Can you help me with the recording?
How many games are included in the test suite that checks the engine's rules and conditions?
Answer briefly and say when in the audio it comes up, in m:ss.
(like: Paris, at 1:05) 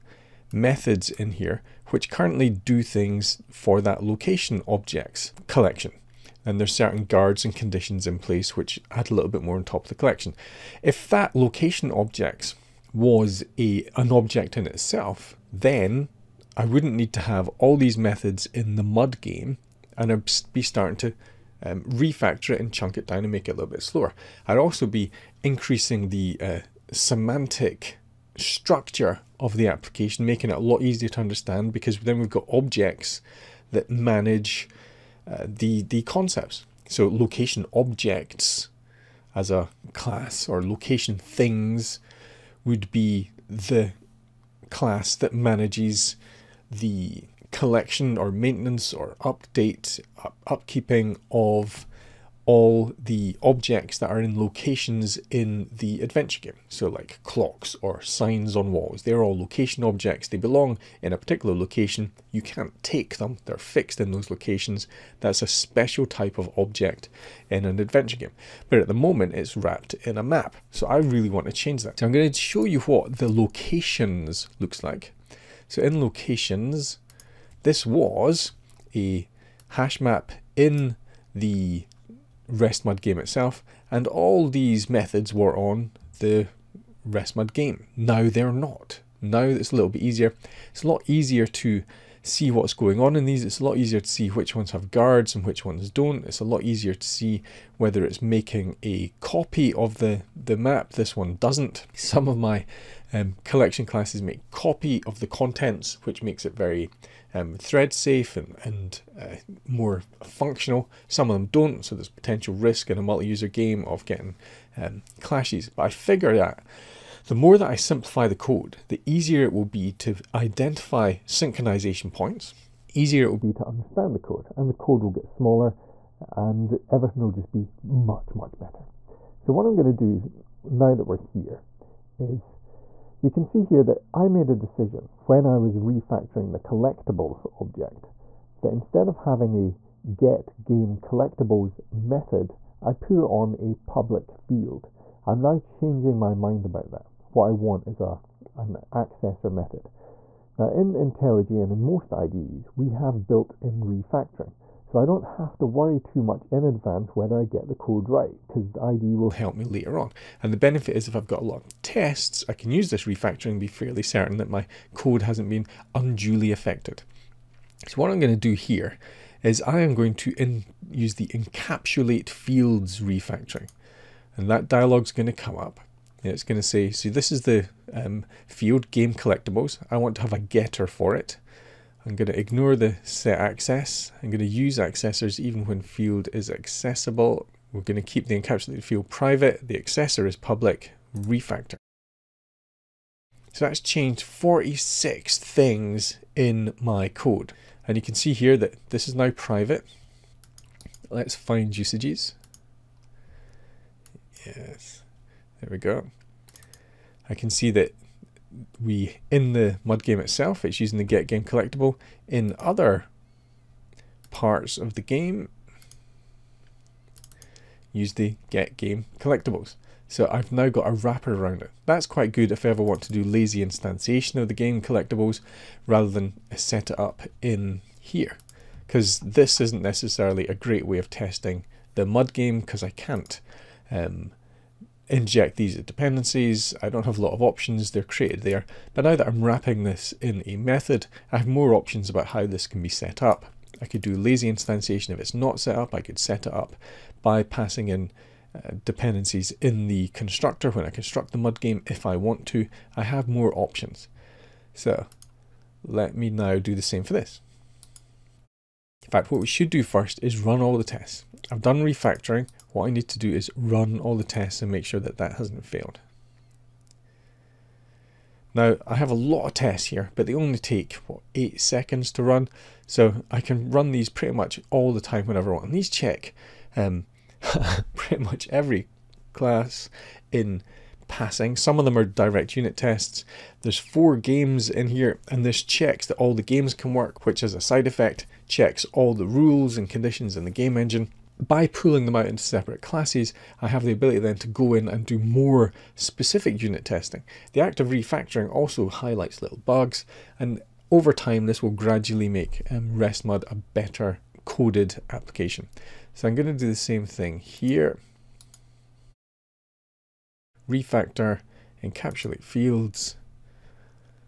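4, at 4:43.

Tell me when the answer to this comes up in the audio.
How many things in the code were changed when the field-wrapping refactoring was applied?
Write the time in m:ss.
3:14.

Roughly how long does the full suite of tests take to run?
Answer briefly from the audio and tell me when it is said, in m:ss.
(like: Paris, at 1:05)
8 seconds, at 4:31.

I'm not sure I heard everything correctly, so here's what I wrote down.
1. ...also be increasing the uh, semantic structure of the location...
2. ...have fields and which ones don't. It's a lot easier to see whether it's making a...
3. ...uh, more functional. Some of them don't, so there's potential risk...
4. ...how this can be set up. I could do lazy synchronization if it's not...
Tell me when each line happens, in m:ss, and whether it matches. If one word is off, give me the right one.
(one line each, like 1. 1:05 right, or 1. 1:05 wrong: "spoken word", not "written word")
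1. 0:24 wrong: "application", not "location"
2. 1:34 wrong: "guards", not "fields"
3. 1:49 right
4. 4:02 wrong: "instantiation", not "synchronization".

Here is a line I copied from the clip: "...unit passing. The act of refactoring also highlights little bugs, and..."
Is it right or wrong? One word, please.
wrong.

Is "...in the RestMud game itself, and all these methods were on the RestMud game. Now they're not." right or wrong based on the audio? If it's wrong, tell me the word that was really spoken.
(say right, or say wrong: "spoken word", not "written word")
right.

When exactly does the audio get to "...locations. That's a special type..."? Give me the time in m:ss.
1:04.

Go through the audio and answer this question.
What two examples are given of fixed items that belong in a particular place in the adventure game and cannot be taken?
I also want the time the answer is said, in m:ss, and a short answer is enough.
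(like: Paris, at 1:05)
Clocks or signs, at 0:57.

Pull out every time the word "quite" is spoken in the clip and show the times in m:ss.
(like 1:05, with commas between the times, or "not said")
3:42.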